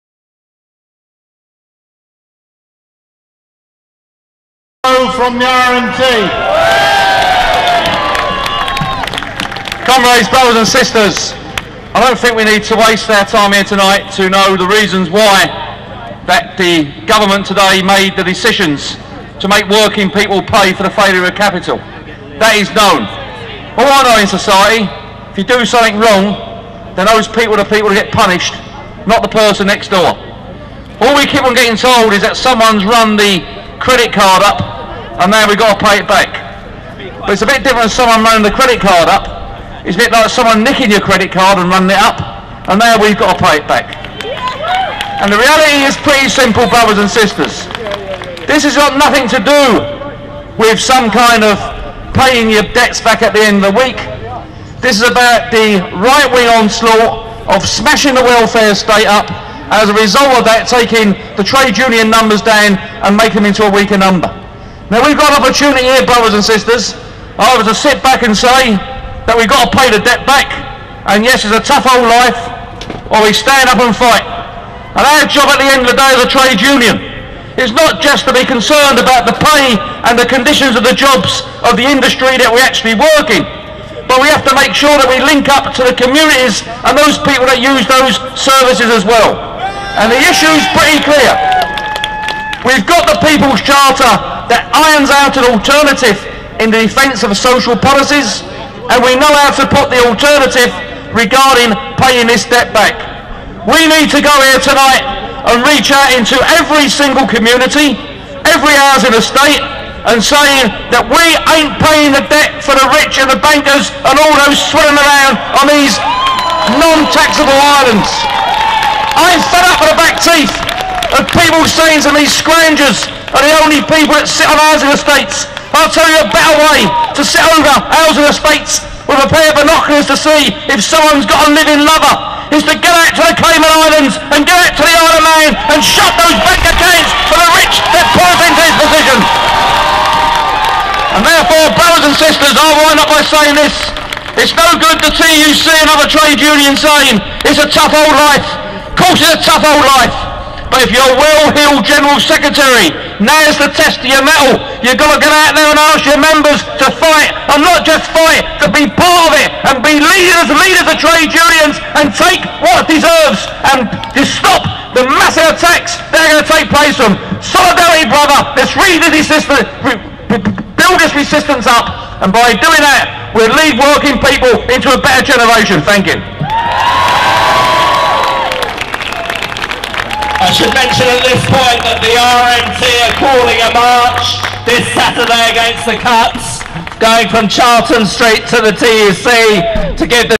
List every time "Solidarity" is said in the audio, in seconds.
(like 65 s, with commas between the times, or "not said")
167 s.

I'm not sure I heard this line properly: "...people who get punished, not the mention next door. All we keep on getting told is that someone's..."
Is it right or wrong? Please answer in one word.
wrong.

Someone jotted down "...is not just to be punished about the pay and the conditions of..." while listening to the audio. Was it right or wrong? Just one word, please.
wrong.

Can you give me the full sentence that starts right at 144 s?
It's no good the TUC and other trade unions saying it's a tough old life.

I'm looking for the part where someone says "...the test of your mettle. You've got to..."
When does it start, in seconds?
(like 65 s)
153 s.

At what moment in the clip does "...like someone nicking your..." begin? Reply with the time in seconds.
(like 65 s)
40 s.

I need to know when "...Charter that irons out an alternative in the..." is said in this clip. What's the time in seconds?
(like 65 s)
93 s.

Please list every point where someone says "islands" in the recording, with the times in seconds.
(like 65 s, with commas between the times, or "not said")
117 s, 133 s.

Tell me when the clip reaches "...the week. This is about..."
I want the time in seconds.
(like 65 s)
53 s.